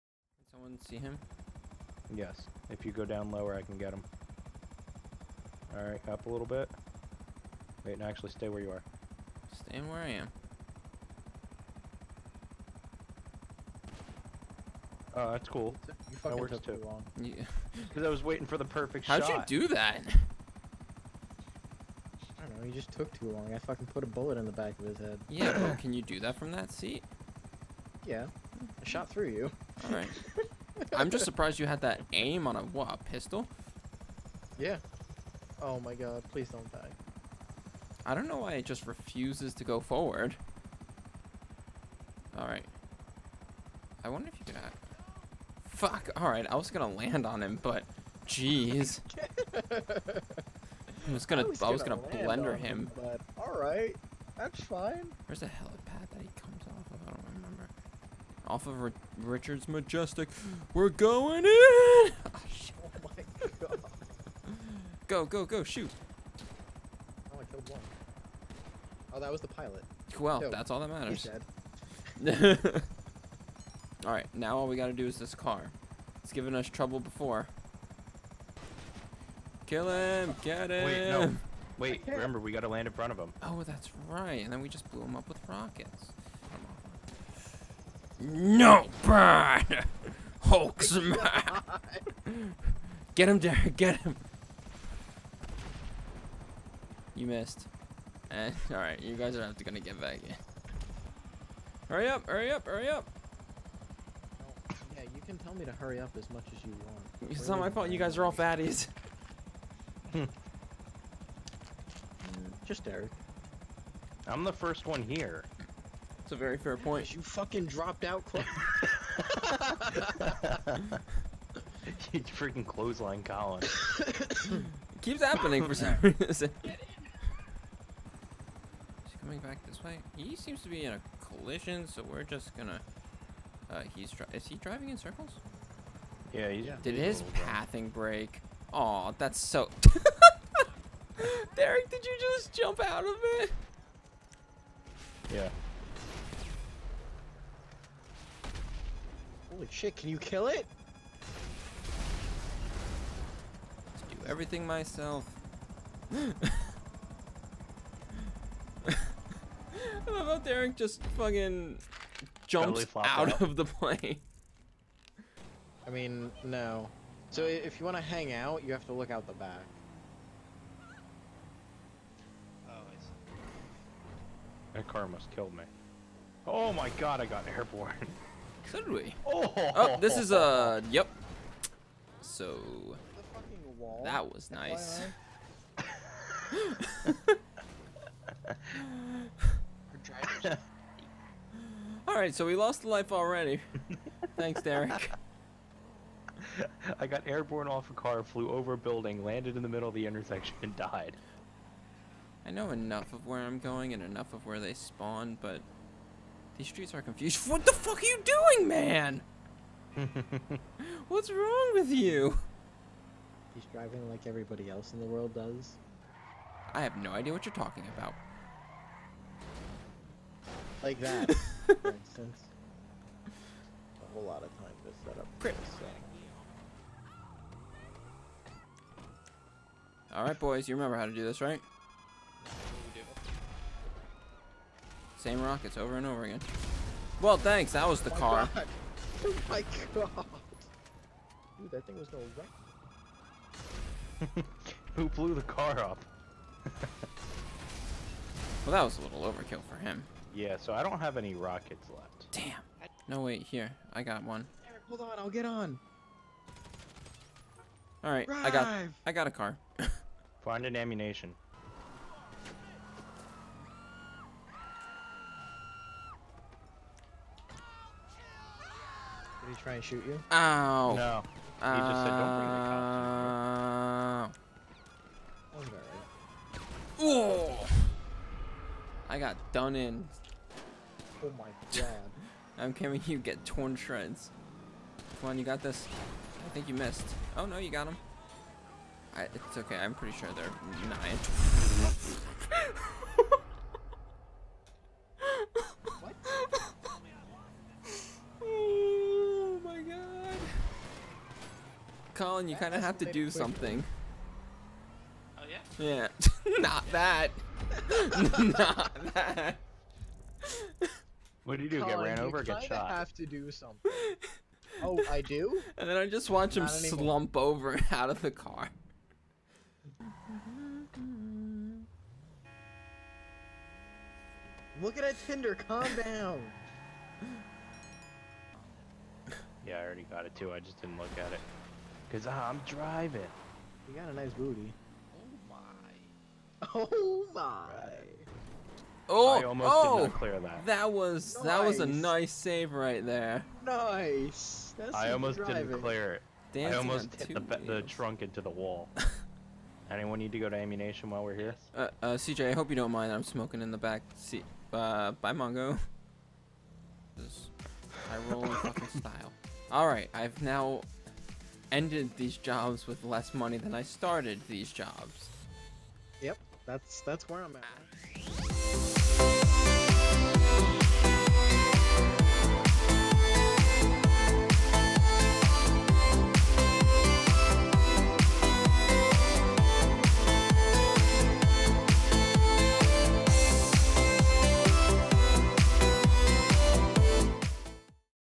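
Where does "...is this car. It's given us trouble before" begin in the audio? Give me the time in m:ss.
1:15.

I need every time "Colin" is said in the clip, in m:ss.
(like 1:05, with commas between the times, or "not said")
2:03, 5:02, 5:11.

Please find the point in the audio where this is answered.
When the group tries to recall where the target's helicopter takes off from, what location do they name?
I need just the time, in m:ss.
0:59.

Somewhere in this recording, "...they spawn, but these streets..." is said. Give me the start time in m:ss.
3:24.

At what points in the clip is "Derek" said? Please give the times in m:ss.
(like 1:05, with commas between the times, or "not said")
1:33, 1:52, 2:21, 2:40, 3:14.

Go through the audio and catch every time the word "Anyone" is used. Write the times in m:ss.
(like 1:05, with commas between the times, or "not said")
5:49.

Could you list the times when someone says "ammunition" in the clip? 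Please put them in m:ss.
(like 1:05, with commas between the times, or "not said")
4:20, 5:50.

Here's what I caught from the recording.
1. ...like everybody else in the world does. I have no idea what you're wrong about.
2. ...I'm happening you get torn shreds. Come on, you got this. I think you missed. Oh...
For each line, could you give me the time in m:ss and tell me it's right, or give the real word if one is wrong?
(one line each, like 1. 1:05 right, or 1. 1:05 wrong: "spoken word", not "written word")
1. 3:34 wrong: "talking", not "wrong"
2. 4:42 wrong: "coming", not "happening".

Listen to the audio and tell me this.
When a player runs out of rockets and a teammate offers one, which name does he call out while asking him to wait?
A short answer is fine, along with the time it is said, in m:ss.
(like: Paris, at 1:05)
Eric, at 4:14.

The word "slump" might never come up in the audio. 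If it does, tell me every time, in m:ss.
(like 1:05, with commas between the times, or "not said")
5:16.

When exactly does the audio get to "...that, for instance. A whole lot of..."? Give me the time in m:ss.
3:40.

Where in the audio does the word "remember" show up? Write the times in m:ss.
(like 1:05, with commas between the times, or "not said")
0:57, 1:22, 3:50.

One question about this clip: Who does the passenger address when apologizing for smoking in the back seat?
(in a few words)
CJ.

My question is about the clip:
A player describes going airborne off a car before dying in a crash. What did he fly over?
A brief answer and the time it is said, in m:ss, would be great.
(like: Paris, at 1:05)
A building, at 3:18.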